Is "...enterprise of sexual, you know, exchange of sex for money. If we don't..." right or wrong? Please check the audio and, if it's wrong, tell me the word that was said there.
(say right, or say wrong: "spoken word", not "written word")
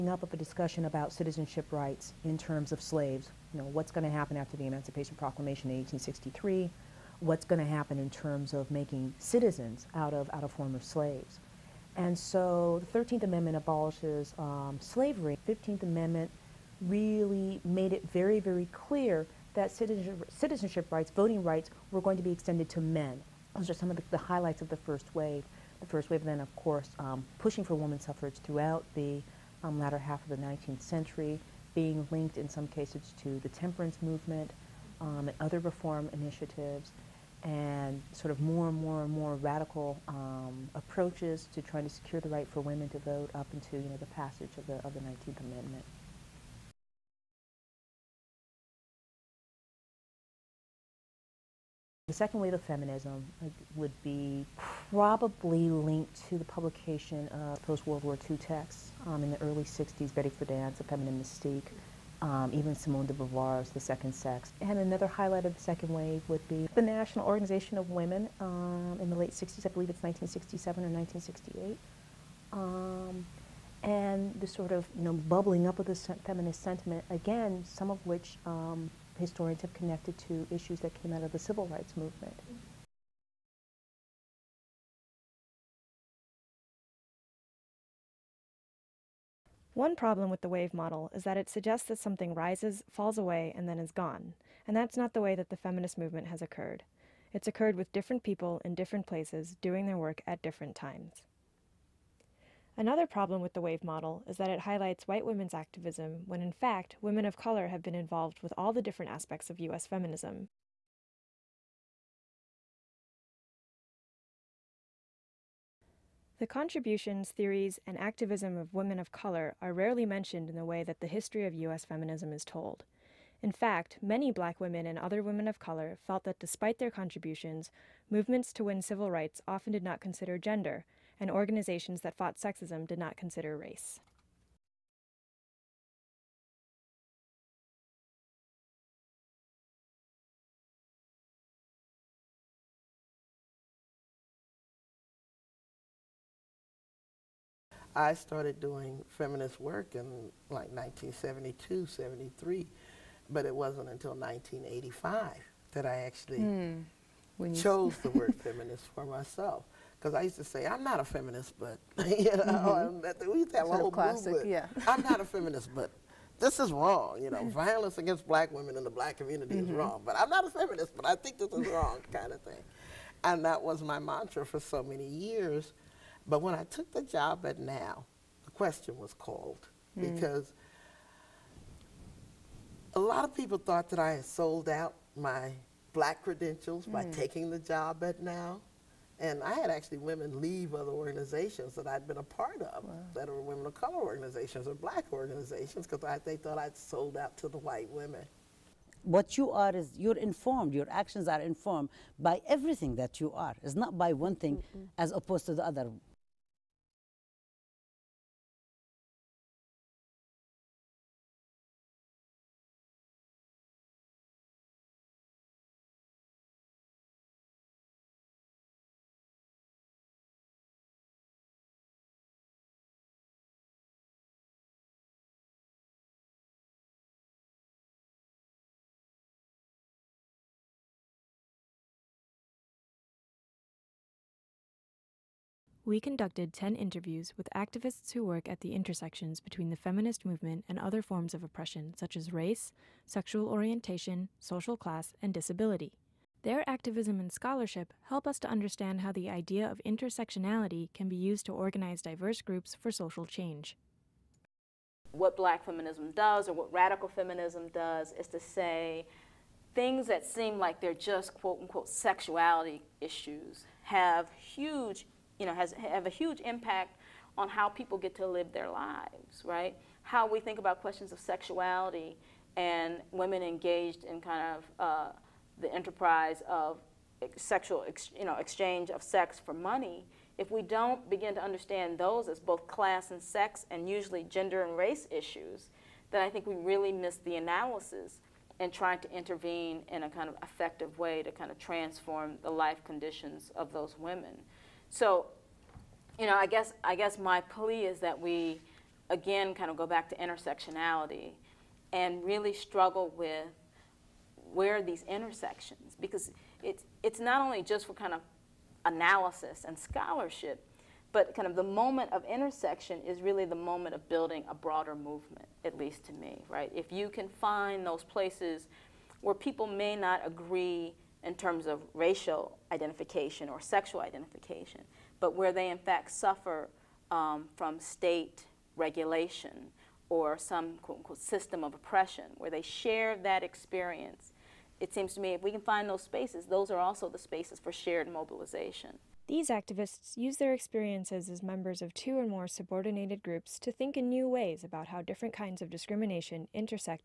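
right.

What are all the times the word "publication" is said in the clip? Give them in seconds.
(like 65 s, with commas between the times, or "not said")
56 s.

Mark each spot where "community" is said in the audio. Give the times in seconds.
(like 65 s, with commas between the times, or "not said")
169 s.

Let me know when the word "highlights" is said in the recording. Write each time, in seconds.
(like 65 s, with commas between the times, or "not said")
24 s, 65 s, 104 s.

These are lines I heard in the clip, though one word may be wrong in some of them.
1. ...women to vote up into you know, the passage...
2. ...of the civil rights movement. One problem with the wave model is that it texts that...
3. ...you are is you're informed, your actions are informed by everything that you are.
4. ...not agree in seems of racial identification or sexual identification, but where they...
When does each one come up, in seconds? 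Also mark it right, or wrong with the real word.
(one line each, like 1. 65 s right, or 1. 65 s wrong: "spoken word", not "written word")
1. 42 s right
2. 81 s wrong: "suggests", not "texts"
3. 199 s right
4. 319 s wrong: "terms", not "seems".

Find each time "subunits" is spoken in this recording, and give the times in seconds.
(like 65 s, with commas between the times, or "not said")
not said.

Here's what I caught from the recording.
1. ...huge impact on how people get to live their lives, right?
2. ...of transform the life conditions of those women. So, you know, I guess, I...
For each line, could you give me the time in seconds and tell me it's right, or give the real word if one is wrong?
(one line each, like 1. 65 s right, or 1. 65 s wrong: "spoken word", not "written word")
1. 266 s right
2. 291 s right.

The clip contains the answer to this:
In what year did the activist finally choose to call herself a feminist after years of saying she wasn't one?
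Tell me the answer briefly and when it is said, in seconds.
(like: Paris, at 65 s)
1985, at 154 s.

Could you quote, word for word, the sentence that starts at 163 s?
we used to have a whole classic, movement.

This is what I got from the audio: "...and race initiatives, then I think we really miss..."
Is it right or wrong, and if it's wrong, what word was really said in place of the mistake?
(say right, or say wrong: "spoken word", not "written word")
wrong: "issues", not "initiatives".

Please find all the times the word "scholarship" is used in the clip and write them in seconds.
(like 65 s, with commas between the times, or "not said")
247 s, 309 s.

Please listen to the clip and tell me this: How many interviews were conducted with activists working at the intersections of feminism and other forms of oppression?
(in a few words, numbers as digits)
10.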